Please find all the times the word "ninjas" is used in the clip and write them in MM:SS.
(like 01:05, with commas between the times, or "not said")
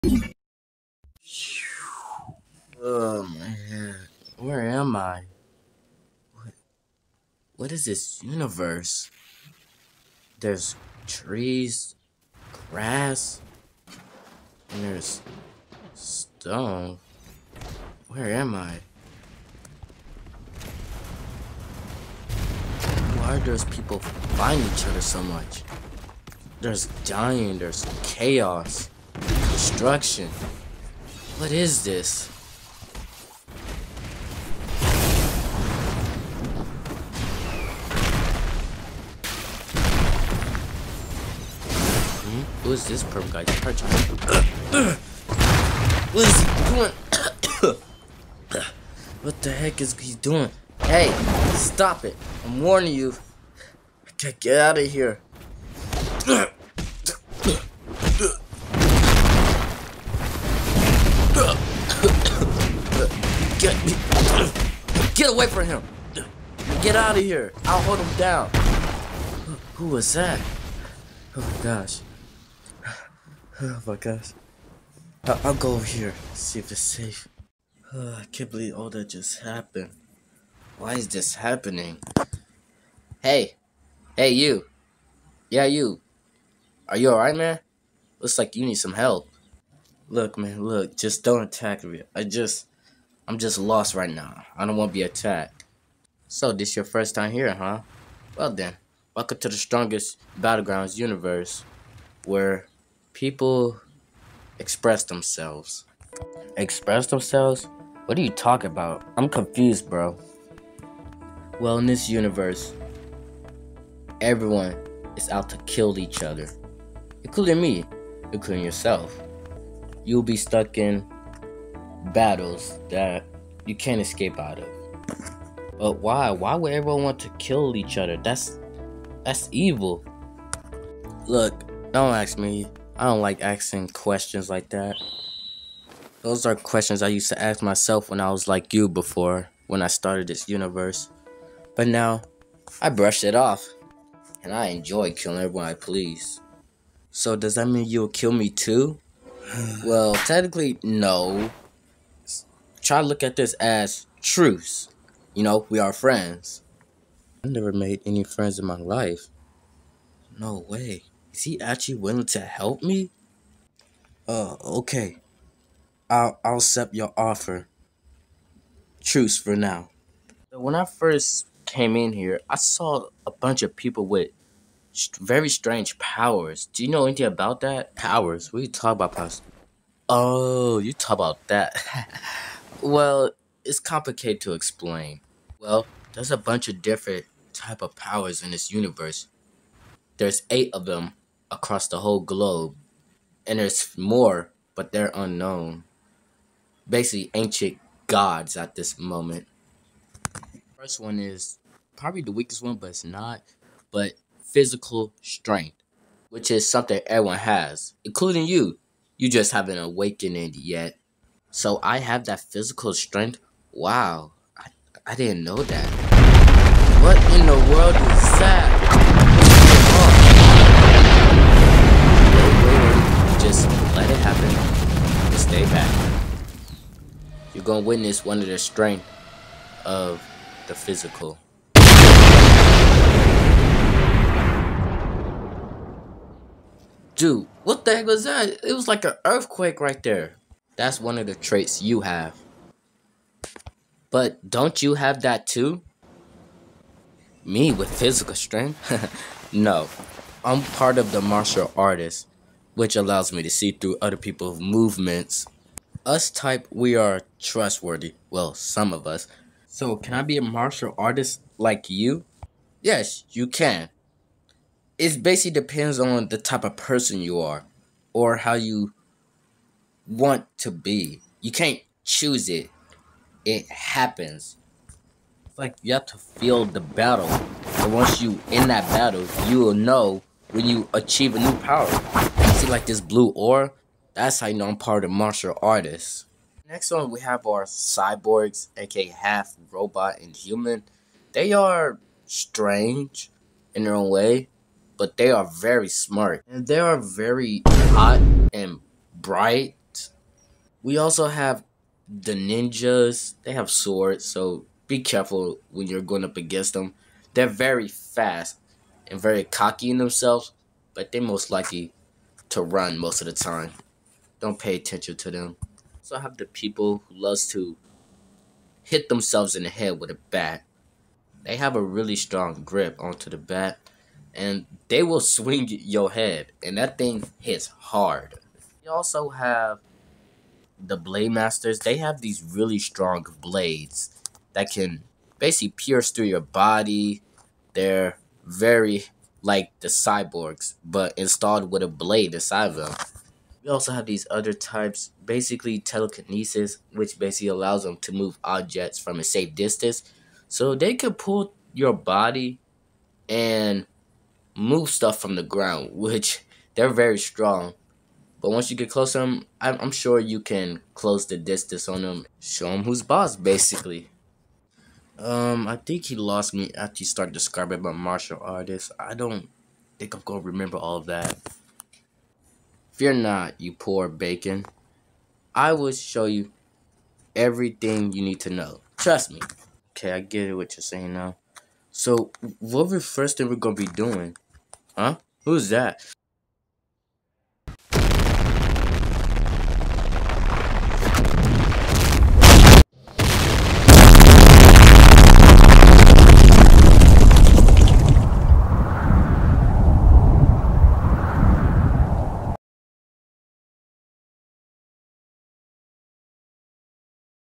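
05:02.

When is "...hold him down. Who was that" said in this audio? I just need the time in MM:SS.
01:07.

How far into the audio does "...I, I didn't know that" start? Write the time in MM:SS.
03:34.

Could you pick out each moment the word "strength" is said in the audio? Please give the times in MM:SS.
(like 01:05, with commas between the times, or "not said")
03:25, 03:32, 03:48, 04:08.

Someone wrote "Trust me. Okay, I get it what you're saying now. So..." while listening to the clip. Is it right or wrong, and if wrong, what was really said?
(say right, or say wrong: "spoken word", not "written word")
right.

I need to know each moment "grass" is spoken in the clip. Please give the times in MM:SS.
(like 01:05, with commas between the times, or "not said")
00:12.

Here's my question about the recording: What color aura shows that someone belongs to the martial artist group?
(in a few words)
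Blue.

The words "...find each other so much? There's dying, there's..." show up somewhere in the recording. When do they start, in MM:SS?
00:23.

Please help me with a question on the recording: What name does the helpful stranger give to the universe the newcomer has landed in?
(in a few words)
Strongest Battlegrounds.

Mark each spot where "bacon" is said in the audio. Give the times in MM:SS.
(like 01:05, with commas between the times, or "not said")
06:14.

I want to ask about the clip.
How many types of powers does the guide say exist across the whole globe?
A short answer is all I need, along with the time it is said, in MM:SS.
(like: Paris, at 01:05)
8, at 03:10.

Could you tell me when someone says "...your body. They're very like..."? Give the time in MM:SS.
05:36.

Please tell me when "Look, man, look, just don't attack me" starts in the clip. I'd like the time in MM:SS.
01:30.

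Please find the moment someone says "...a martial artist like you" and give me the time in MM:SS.
04:20.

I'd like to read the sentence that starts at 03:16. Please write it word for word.
Basically, ancient gods at this moment.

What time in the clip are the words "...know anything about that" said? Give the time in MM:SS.
02:56.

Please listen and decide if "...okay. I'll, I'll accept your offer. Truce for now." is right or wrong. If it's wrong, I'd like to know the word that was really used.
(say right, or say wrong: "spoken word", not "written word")
right.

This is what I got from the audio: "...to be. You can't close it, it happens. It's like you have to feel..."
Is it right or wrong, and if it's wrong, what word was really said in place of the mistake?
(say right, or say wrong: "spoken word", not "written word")
wrong: "choose", not "close".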